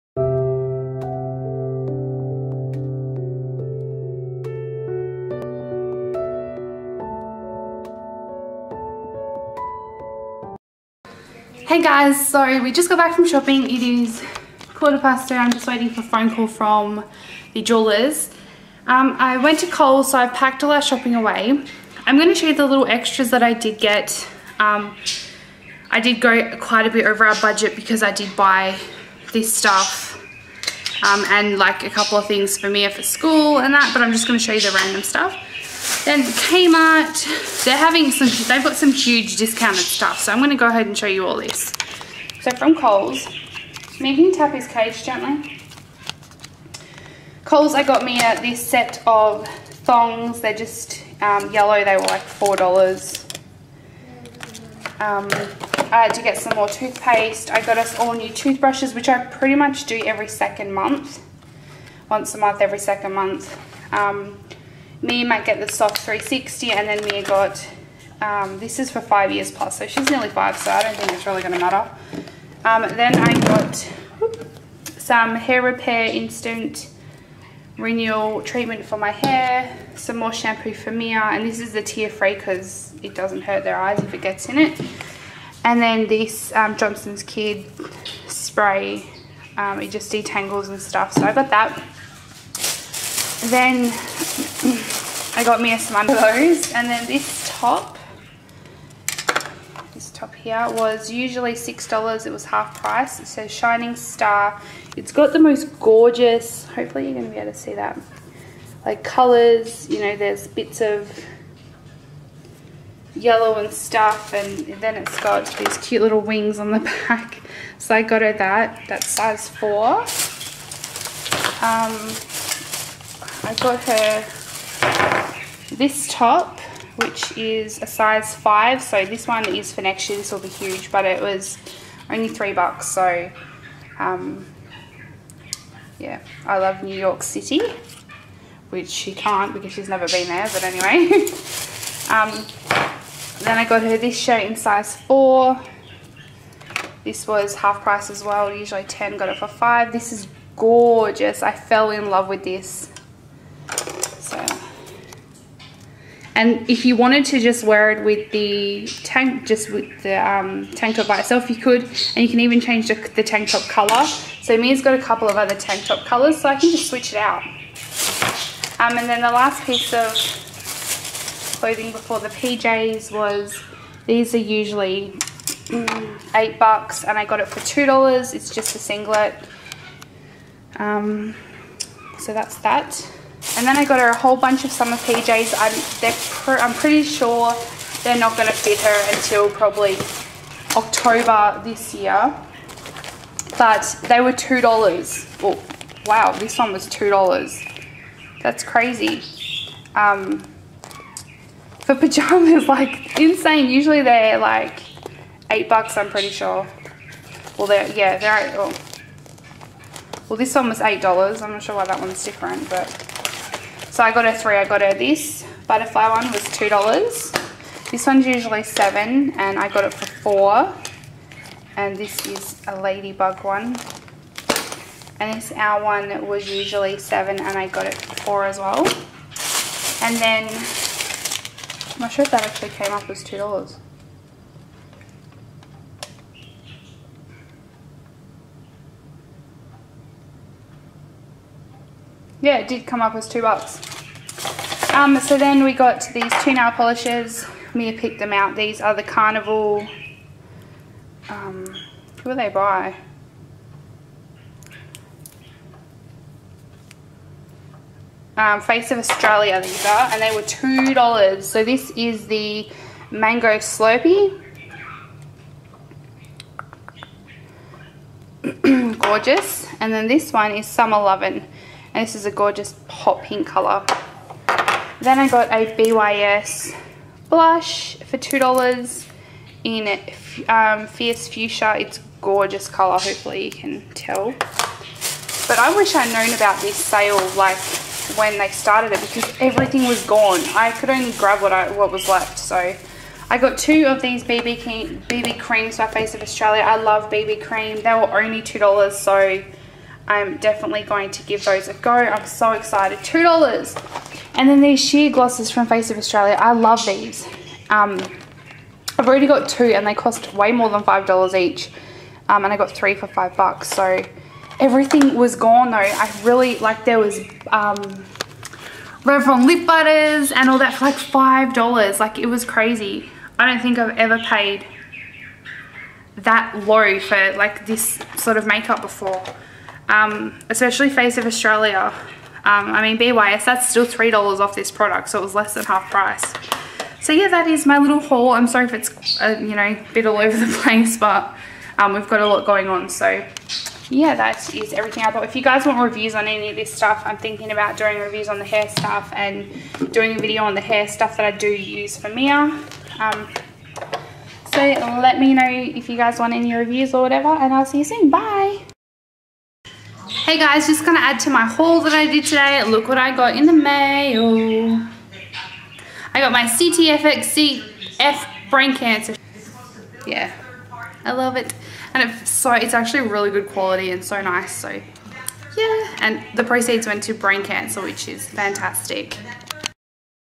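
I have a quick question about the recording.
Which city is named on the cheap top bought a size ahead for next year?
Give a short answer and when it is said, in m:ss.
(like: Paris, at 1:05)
New York City, at 2:16.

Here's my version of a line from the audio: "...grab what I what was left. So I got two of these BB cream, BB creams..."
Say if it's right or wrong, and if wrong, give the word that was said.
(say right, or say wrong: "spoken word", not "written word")
right.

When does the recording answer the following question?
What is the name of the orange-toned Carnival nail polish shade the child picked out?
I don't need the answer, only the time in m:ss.
4:23.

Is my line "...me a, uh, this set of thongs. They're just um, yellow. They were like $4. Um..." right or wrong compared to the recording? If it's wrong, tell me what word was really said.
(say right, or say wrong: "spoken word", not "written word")
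right.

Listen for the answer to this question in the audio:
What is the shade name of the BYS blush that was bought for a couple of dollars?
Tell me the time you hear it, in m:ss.
4:40.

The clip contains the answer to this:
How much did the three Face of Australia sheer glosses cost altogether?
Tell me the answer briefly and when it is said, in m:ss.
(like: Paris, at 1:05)
$5, at 5:13.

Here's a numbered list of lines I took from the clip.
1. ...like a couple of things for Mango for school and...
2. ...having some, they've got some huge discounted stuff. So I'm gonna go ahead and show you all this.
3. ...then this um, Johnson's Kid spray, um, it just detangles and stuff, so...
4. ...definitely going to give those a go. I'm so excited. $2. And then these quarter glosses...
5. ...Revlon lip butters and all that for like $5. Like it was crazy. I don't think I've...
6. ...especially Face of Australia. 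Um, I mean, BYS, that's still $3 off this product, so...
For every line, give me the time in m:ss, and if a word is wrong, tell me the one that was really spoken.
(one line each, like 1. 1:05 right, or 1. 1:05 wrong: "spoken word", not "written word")
1. 0:31 wrong: "Mia", not "Mango"
2. 0:37 right
3. 1:25 right
4. 5:00 wrong: "sheer", not "quarter"
5. 5:19 right
6. 5:30 right.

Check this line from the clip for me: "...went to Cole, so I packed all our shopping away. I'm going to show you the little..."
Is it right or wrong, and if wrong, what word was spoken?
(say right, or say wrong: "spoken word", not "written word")
right.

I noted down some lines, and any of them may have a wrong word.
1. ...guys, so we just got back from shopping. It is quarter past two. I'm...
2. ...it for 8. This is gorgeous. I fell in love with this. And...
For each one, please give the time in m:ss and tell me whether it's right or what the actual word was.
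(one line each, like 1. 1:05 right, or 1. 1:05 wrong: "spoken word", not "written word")
1. 0:11 right
2. 2:29 wrong: "5", not "8".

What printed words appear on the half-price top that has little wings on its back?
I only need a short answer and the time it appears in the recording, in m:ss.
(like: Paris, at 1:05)
Shining Star, at 1:43.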